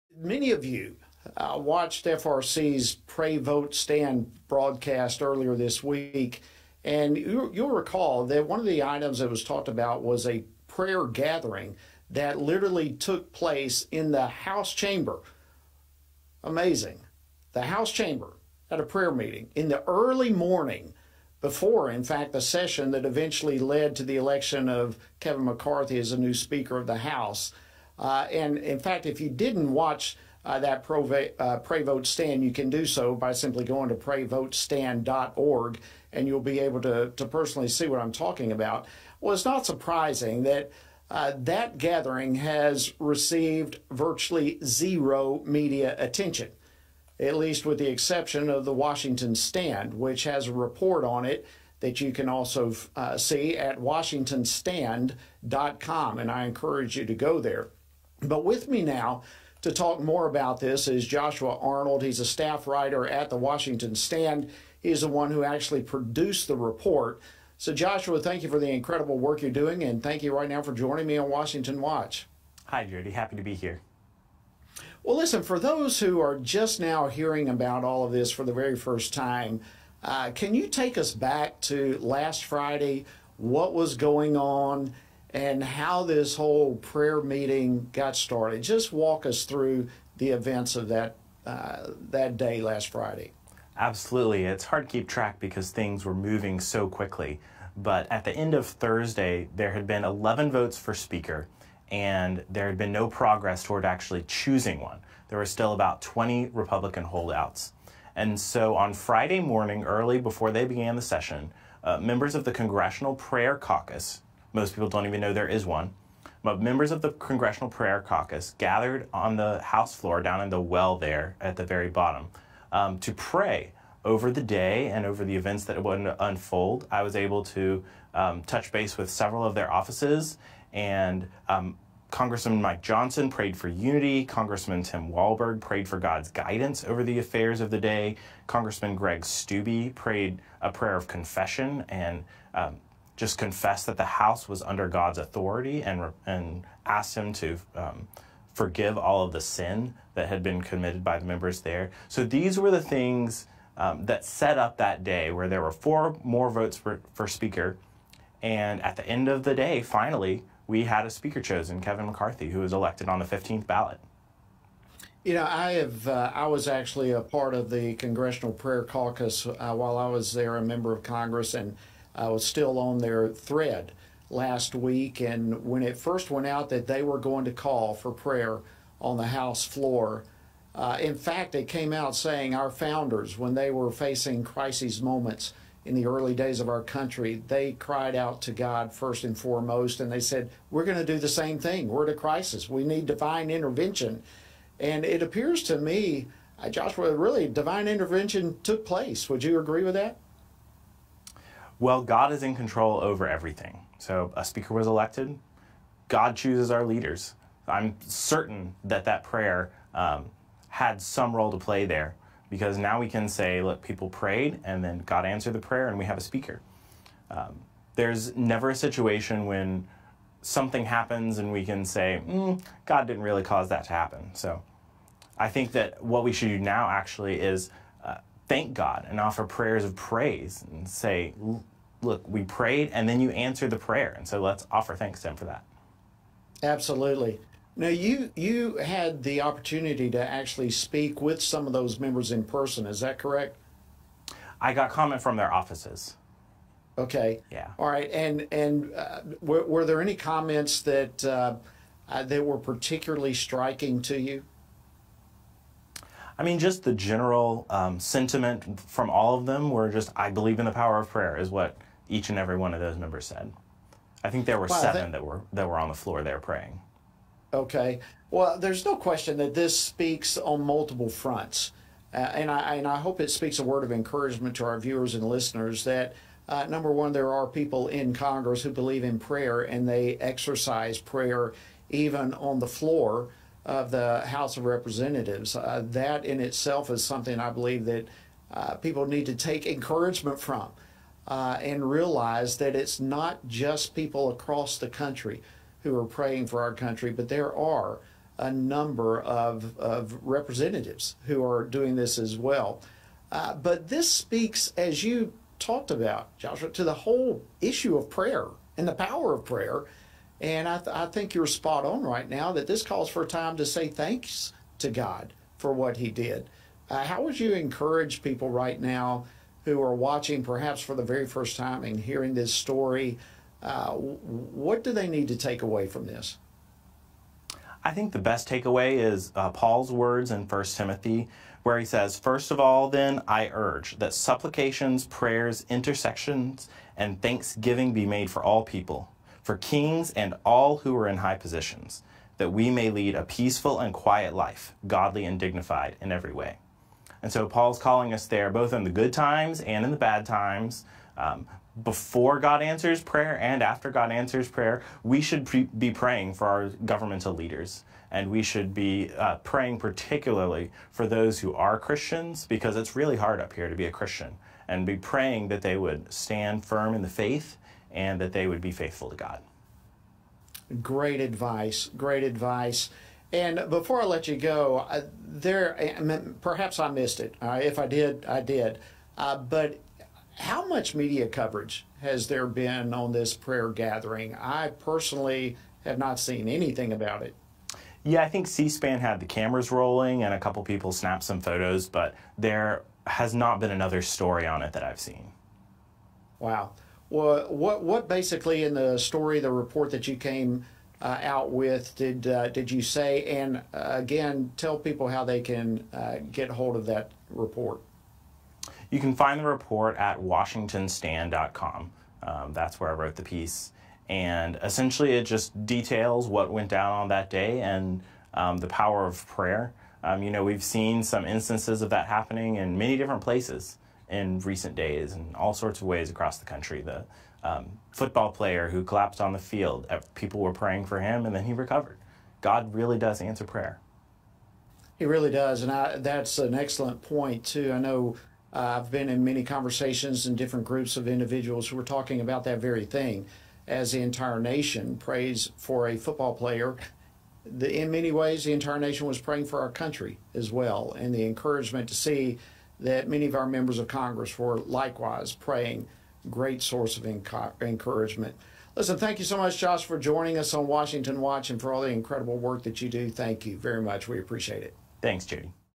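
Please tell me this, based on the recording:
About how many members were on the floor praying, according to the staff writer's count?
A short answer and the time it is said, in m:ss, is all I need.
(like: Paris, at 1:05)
7, at 4:24.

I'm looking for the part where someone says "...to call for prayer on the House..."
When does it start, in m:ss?
2:57.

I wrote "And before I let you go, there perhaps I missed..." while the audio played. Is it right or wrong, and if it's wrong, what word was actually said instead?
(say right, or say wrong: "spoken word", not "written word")
right.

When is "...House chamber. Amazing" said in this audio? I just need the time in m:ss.
0:14.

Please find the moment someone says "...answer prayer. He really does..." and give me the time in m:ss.
7:13.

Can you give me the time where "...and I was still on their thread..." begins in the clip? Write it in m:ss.
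2:51.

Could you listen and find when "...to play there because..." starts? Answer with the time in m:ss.
3:31.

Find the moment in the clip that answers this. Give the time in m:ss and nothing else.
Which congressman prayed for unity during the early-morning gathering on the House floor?
2:12.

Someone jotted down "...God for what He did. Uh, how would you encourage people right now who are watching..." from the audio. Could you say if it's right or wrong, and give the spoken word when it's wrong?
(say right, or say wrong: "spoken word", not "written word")
right.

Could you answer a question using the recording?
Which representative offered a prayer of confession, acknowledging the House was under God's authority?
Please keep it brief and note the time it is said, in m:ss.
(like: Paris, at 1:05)
Greg Steube, at 2:18.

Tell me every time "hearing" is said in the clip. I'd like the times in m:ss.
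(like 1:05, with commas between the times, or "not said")
1:17, 5:21.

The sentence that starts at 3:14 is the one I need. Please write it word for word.
And it appears to me, uh, Joshua, really, divine intervention took place.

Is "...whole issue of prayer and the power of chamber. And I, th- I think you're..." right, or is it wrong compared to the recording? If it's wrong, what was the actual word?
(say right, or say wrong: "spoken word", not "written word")
wrong: "prayer", not "chamber".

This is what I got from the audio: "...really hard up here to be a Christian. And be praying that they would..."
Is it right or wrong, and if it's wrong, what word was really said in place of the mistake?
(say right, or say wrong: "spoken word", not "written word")
right.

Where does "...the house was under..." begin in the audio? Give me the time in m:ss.
2:23.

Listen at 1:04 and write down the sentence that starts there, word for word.
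He's the one who actually produced the report.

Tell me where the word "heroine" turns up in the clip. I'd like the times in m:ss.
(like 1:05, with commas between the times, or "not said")
not said.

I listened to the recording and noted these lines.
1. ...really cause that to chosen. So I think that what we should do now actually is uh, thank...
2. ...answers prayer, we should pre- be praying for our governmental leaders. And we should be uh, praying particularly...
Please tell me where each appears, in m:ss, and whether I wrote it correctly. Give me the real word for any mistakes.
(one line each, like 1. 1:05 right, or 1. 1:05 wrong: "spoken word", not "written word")
1. 3:43 wrong: "happen", not "chosen"
2. 5:54 right.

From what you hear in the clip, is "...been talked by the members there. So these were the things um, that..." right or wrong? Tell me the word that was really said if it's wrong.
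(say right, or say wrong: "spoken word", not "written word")
wrong: "committed", not "talked".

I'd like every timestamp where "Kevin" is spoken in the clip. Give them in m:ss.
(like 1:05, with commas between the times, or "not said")
0:25, 2:41.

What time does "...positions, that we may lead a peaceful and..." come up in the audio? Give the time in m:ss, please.
5:41.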